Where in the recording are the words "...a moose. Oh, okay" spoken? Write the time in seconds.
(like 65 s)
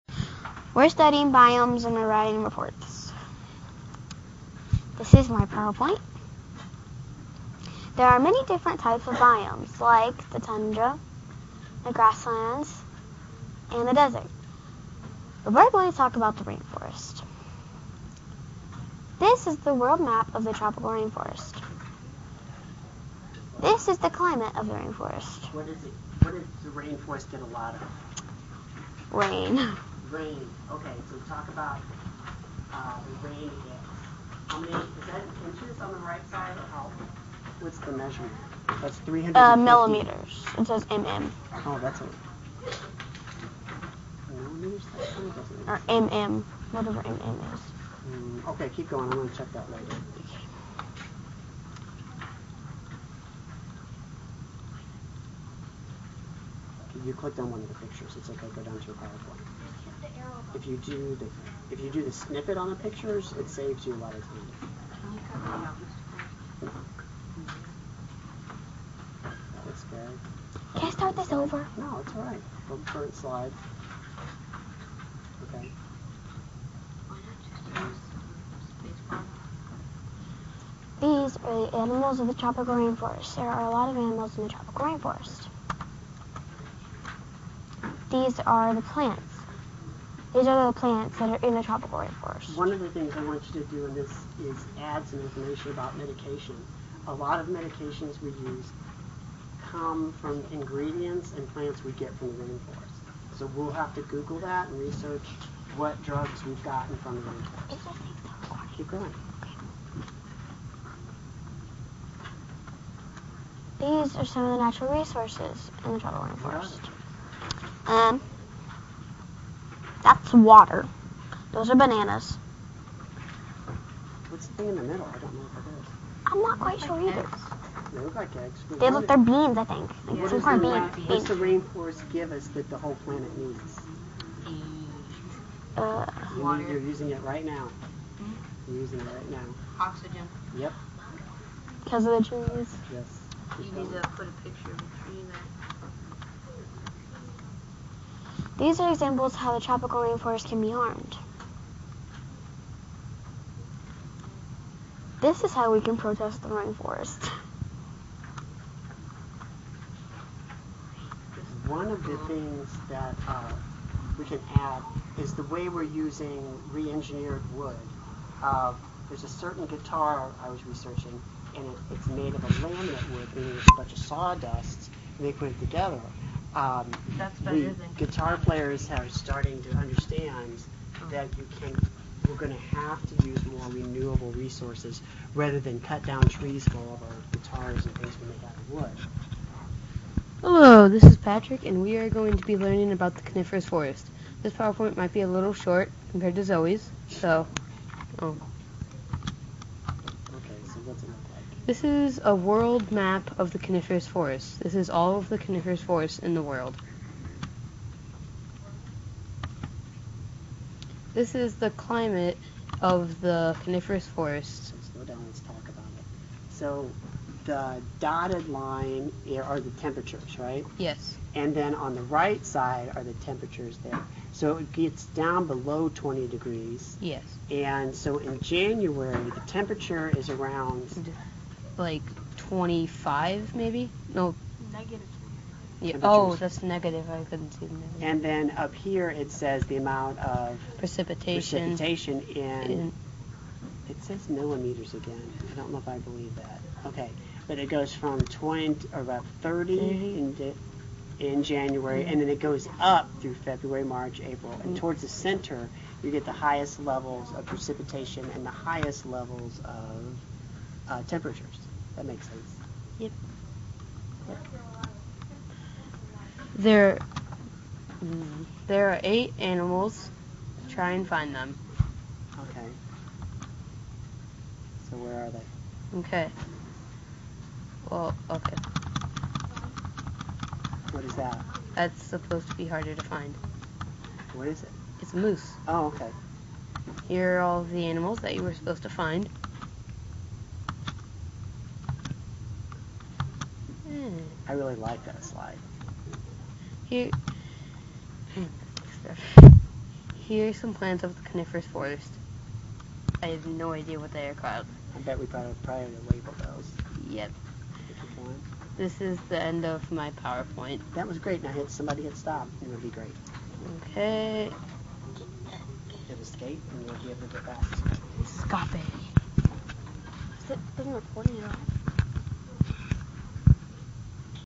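285 s.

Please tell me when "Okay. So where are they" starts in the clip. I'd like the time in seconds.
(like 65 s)
272 s.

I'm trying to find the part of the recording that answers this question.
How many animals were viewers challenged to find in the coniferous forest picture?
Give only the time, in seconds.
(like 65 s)
269 s.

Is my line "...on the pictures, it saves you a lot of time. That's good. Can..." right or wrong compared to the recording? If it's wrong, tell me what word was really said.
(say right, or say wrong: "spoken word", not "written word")
right.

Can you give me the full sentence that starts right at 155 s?
This is how we can protest the rainforest.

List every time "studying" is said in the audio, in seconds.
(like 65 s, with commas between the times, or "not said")
0 s.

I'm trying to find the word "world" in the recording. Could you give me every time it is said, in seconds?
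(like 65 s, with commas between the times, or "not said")
19 s, 202 s, 206 s.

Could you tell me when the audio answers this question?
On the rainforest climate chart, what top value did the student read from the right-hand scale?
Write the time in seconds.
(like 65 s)
39 s.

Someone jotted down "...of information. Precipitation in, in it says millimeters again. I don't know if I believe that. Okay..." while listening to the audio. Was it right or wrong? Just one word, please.
wrong.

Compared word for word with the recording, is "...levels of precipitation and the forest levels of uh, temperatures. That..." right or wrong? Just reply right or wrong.
wrong.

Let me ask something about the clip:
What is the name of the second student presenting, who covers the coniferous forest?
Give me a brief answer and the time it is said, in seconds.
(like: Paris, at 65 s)
Patrick, at 191 s.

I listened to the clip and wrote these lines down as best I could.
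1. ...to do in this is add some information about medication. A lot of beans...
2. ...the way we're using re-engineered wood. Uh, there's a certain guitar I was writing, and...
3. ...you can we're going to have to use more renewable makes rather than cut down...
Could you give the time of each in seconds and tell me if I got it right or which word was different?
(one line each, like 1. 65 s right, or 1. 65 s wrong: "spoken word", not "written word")
1. 93 s wrong: "medications", not "beans"
2. 165 s wrong: "researching", not "writing"
3. 181 s wrong: "resources", not "makes".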